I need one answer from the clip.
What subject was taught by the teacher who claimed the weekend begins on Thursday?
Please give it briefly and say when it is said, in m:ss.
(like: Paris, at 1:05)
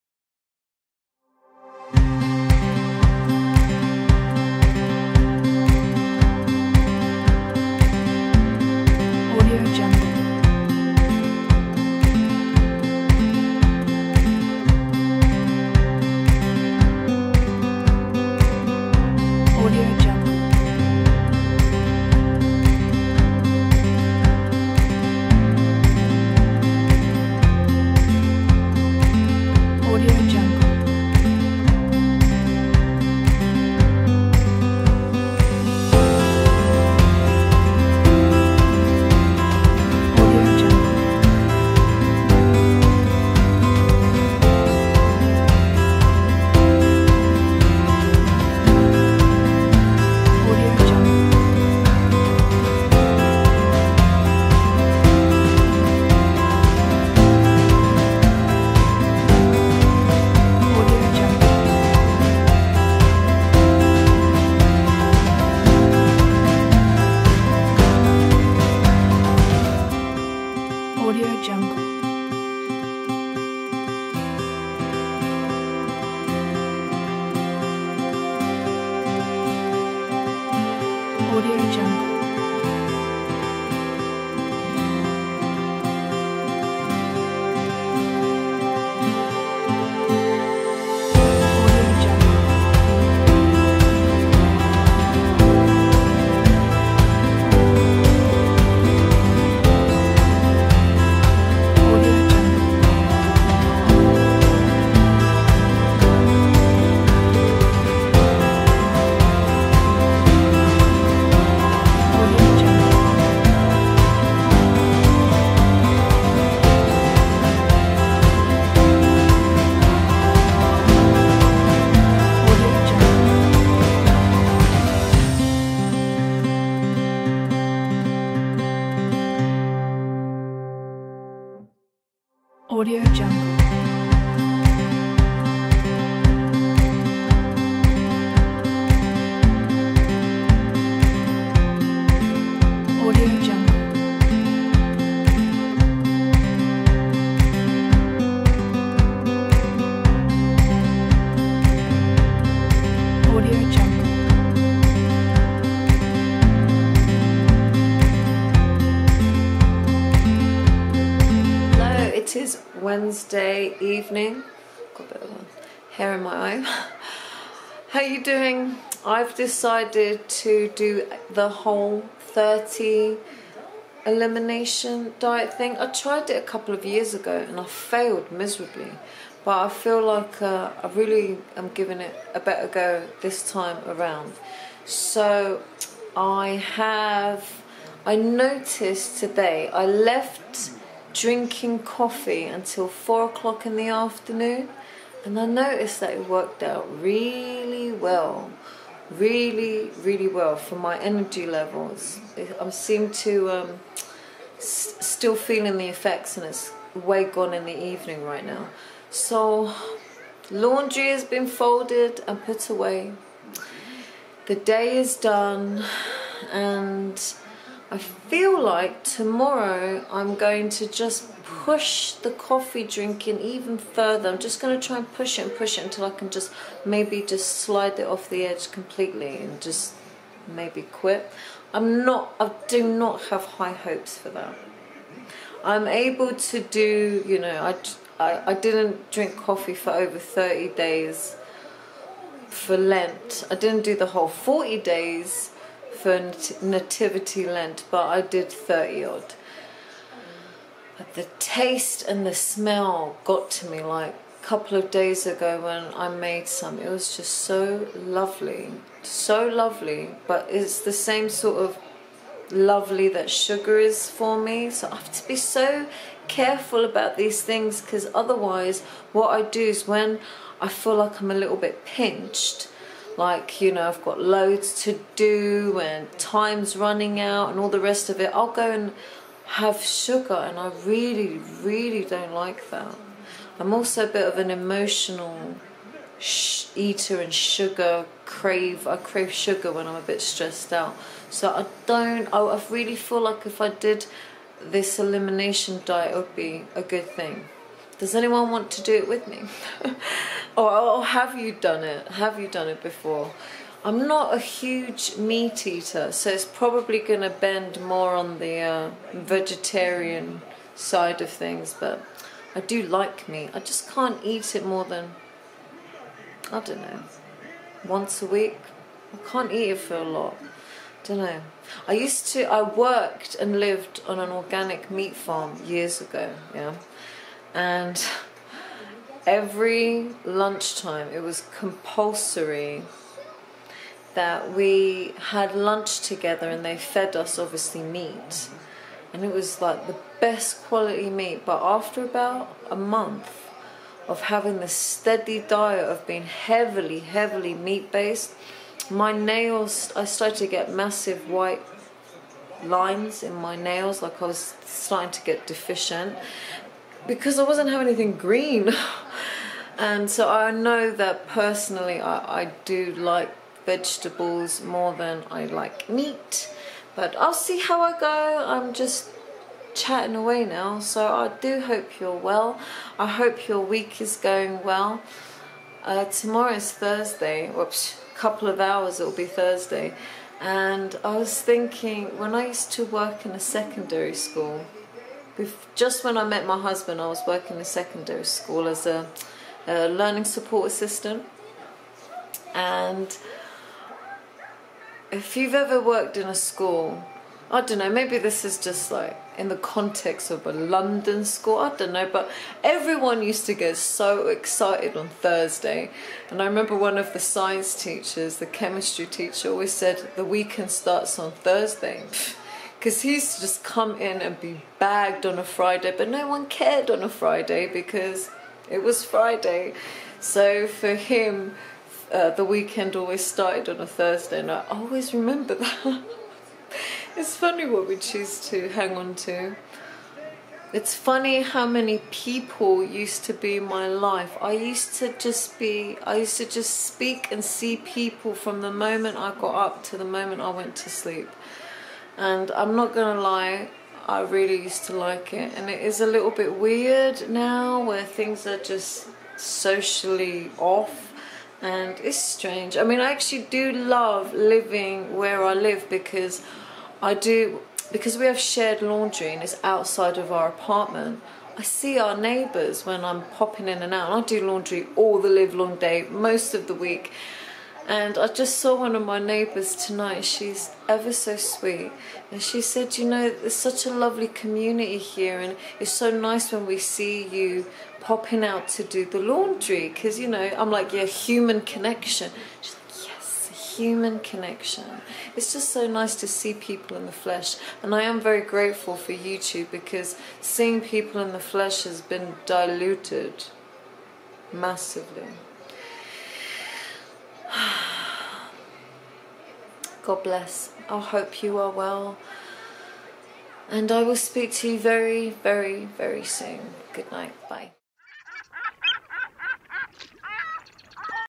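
Chemistry, at 6:48.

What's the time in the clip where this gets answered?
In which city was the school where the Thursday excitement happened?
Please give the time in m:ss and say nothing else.
6:40.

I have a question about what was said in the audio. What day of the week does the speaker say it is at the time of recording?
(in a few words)
Wednesday.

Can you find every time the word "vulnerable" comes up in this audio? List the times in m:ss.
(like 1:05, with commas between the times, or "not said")
not said.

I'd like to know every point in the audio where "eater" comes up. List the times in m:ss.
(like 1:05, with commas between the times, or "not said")
4:46, 5:05.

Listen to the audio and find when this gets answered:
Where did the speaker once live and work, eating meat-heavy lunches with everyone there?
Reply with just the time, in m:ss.
5:24.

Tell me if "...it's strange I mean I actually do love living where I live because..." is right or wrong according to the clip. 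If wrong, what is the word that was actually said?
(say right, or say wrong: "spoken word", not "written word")
right.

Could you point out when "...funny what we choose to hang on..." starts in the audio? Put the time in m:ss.
7:07.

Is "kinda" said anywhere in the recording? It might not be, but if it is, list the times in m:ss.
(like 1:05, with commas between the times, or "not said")
not said.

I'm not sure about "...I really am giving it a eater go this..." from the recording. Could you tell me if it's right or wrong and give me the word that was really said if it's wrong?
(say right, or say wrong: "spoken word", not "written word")
wrong: "better", not "eater".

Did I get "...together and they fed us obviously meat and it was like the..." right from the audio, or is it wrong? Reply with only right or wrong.
right.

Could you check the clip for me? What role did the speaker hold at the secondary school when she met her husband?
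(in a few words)
Learning support assistant.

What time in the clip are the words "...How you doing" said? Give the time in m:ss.
2:47.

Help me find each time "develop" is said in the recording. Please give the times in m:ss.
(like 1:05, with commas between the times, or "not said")
not said.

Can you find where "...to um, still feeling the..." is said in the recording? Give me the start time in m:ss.
3:23.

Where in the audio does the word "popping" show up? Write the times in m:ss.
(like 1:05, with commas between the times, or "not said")
7:43, 7:57.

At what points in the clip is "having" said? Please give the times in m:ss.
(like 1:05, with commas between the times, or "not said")
5:44, 5:57.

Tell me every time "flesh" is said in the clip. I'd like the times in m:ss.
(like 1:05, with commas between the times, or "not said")
8:07, 8:11.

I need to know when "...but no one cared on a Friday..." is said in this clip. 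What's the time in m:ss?
6:55.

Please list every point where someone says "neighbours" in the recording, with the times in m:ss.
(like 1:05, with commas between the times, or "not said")
7:42, 7:49.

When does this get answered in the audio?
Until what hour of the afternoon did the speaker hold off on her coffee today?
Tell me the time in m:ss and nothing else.
3:12.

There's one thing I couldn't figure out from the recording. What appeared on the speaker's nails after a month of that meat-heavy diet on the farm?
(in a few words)
White lines.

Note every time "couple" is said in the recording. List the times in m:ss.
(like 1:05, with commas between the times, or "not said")
2:56, 4:14, 6:18.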